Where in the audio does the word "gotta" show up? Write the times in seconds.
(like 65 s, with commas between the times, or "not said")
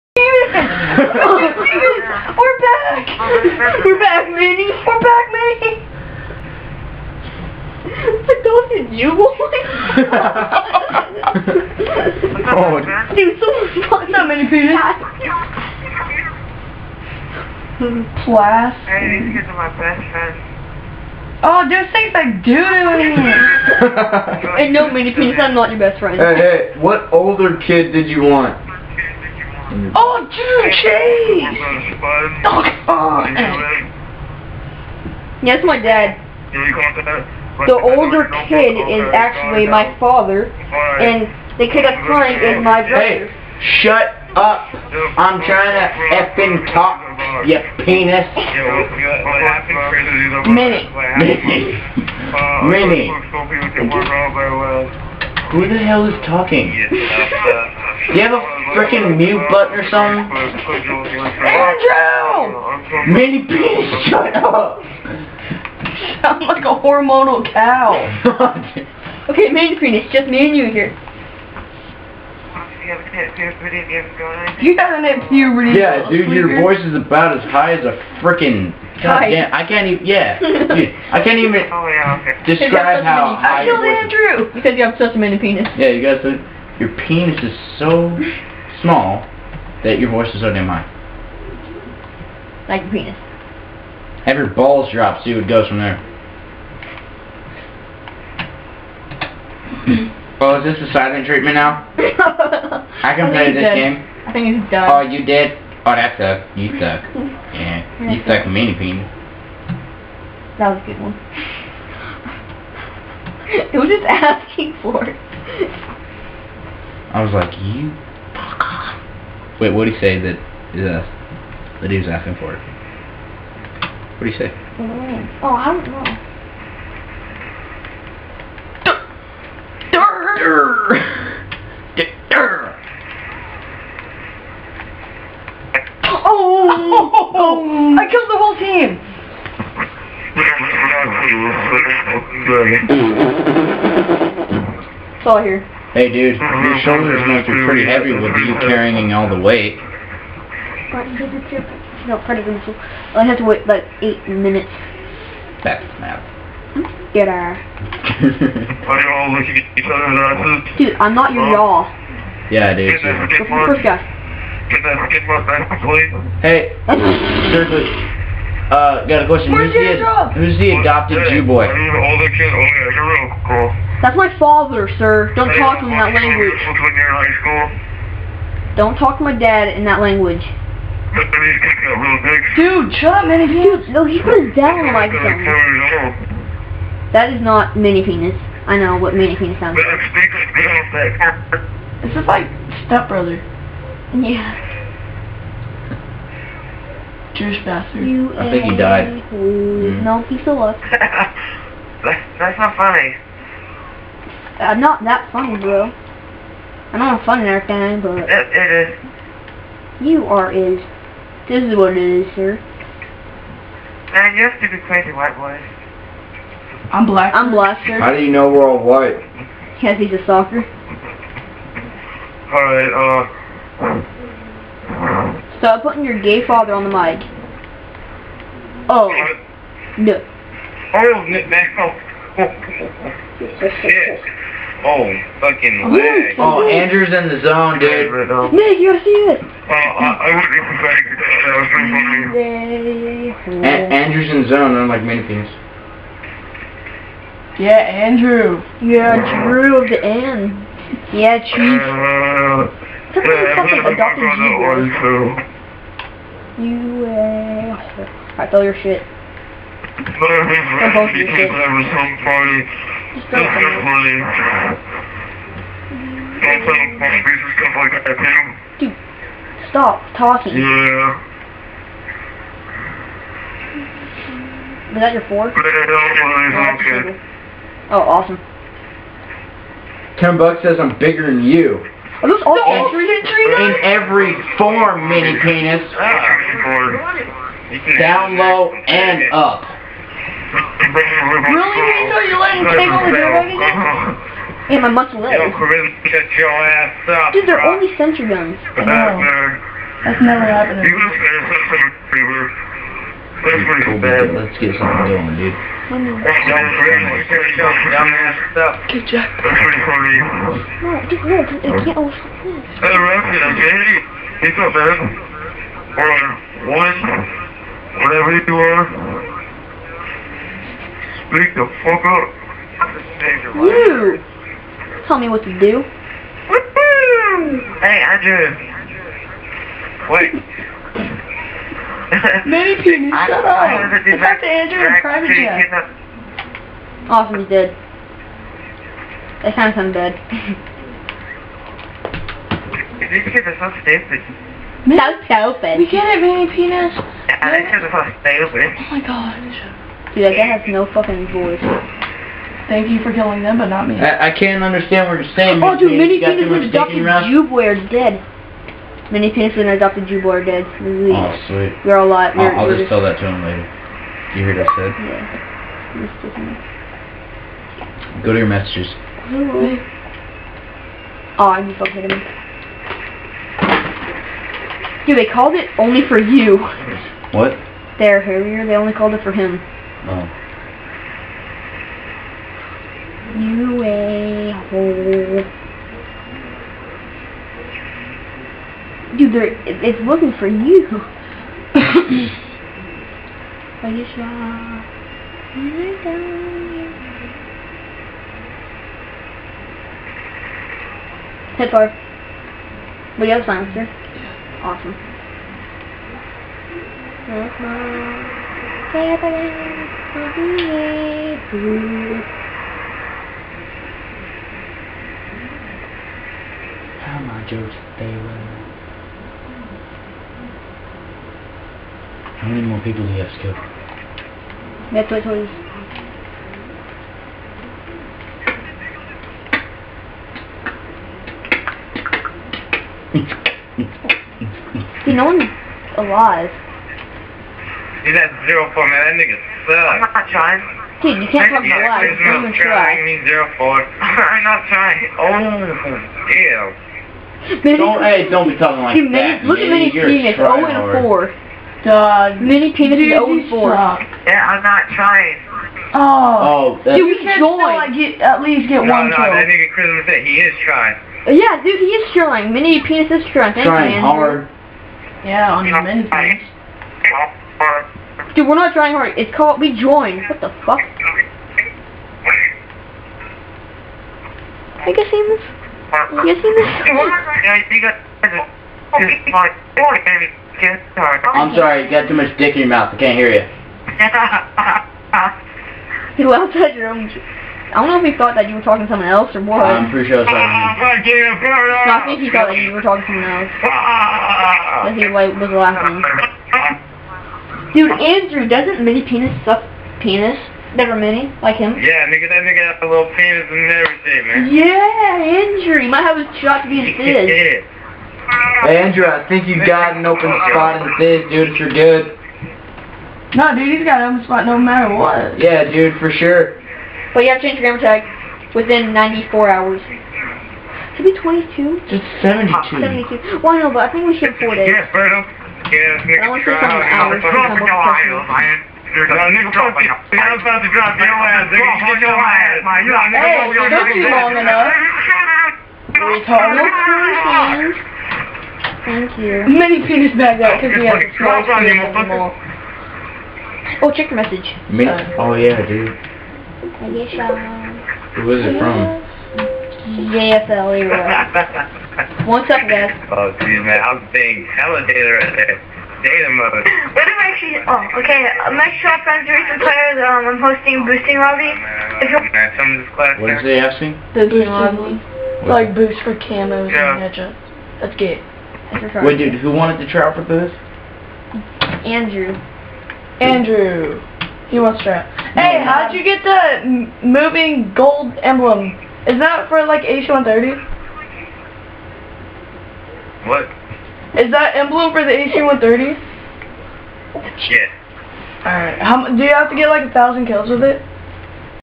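238 s, 301 s.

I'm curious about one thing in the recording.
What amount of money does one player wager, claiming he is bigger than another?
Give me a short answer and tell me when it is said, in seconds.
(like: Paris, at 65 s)
10 dollars, at 280 s.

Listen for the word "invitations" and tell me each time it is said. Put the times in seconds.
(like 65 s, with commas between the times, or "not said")
not said.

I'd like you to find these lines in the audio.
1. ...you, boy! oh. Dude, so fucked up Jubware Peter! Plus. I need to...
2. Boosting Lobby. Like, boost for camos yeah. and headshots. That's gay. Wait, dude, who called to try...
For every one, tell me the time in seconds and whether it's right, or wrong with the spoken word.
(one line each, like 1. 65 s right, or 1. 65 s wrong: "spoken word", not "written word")
1. 8 s wrong: "Minnie", not "Jubware"
2. 564 s wrong: "wanted", not "called".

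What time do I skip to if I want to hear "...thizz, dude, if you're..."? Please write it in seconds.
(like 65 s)
510 s.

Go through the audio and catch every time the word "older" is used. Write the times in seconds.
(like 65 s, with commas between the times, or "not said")
27 s, 37 s, 171 s.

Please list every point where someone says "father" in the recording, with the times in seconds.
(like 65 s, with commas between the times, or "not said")
39 s, 174 s, 226 s.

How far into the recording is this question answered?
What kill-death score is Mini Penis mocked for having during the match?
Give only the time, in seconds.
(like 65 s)
452 s.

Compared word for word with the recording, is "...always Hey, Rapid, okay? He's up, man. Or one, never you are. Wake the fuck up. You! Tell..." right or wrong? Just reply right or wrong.
wrong.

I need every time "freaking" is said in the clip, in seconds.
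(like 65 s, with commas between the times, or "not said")
58 s, 78 s.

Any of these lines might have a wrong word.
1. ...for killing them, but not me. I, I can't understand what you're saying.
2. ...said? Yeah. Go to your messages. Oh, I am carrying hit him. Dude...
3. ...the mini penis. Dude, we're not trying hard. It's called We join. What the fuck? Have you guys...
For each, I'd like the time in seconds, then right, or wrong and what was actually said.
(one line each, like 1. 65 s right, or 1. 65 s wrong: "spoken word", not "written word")
1. 353 s right
2. 364 s wrong: "fucking", not "carrying"
3. 465 s right.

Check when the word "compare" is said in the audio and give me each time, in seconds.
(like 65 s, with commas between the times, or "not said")
not said.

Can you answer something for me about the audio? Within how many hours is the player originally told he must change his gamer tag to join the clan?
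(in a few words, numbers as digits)
94.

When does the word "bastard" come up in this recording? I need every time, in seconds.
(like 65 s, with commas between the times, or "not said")
197 s.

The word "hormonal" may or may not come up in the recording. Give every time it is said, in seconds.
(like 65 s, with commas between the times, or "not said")
66 s.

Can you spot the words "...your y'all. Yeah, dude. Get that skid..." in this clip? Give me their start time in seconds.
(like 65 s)
161 s.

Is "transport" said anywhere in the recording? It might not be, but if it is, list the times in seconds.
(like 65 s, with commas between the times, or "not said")
not said.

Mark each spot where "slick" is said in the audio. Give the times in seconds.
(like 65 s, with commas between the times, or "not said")
not said.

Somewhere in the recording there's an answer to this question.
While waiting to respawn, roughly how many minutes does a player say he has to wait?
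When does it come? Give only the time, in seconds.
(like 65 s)
153 s.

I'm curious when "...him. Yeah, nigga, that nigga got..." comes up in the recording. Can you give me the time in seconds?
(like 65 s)
501 s.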